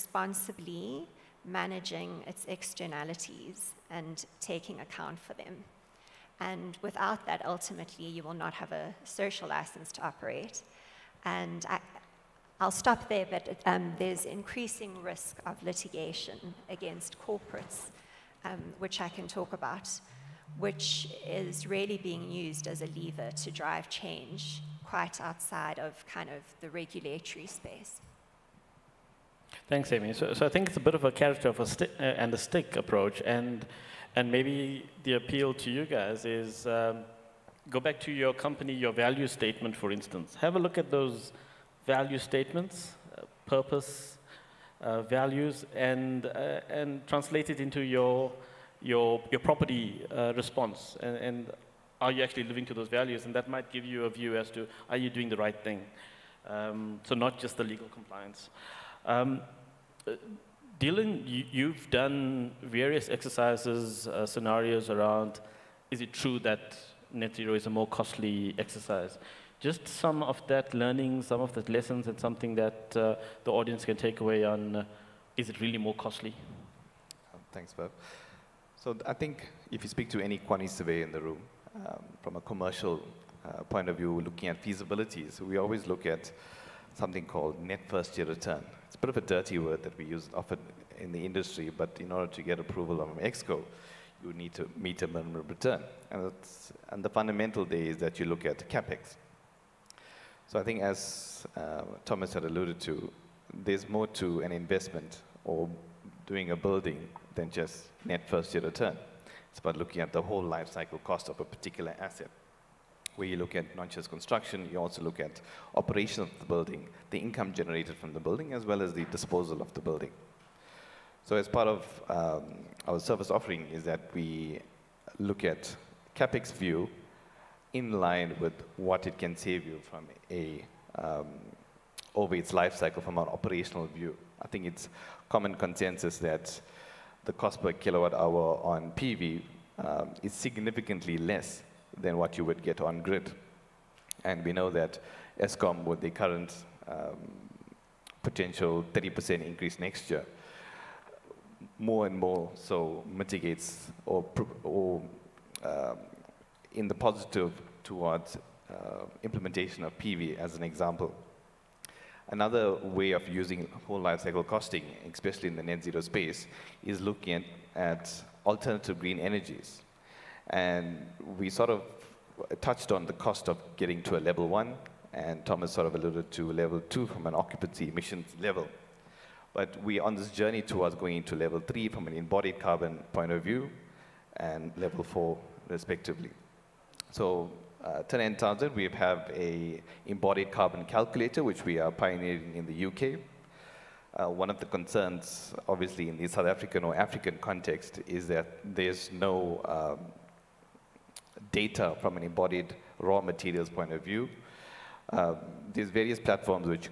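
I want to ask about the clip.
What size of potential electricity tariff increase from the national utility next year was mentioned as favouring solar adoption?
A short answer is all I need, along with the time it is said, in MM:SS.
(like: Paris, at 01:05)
30%, at 02:28.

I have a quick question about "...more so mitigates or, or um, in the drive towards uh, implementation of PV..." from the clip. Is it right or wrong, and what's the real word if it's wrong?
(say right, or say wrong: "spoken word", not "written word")
wrong: "positive", not "drive".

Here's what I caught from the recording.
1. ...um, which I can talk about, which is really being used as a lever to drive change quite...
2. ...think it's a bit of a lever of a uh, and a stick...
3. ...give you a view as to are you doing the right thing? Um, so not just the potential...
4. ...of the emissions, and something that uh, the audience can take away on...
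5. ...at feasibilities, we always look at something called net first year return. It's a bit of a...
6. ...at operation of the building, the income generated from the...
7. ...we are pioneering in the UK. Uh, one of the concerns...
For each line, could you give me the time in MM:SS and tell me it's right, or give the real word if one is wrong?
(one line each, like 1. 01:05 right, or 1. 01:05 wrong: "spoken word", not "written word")
1. 00:18 right
2. 00:30 wrong: "character", not "lever"
3. 00:53 wrong: "legal", not "potential"
4. 01:11 wrong: "lessons", not "emissions"
5. 01:24 right
6. 01:55 right
7. 03:11 right.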